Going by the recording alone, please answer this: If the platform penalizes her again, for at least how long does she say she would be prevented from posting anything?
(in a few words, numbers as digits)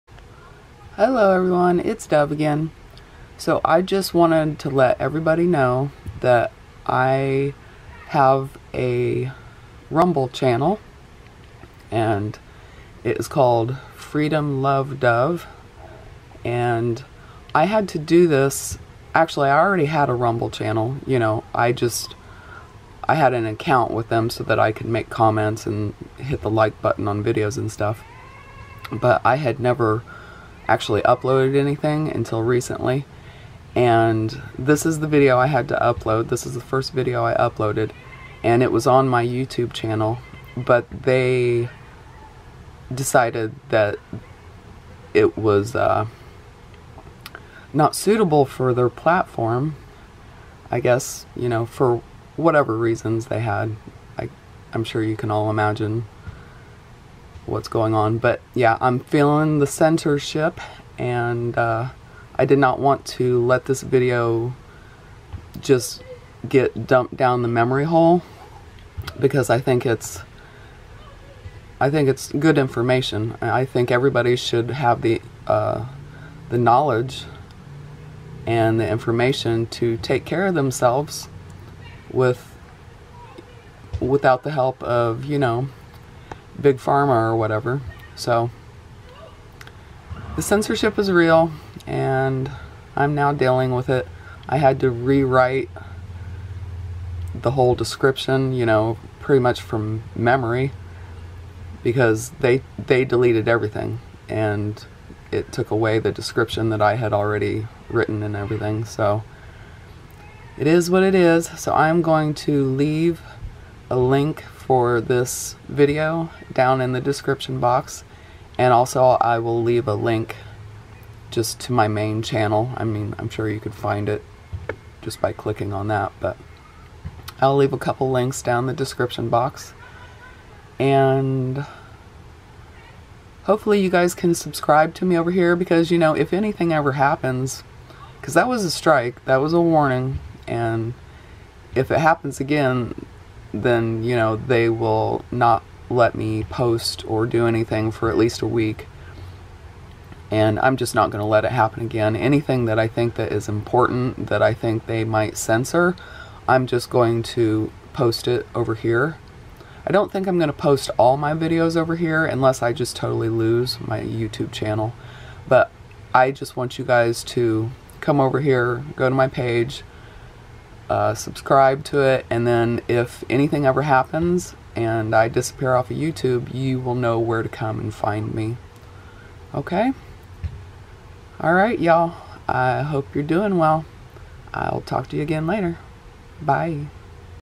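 a week.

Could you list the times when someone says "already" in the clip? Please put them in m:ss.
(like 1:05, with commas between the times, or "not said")
0:19, 1:47.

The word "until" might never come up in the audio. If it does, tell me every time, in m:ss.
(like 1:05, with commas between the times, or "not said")
0:32.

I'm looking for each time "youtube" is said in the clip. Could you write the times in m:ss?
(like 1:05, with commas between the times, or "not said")
0:39, 2:43, 2:55.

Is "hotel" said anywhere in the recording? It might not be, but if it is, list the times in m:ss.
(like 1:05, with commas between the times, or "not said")
not said.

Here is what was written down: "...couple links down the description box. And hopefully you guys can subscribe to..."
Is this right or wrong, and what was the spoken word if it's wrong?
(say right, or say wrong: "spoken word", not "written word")
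right.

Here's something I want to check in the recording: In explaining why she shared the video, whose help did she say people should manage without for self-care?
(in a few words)
big pharma.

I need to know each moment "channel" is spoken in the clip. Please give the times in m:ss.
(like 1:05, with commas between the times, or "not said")
0:10, 0:20, 0:39, 2:02, 2:44.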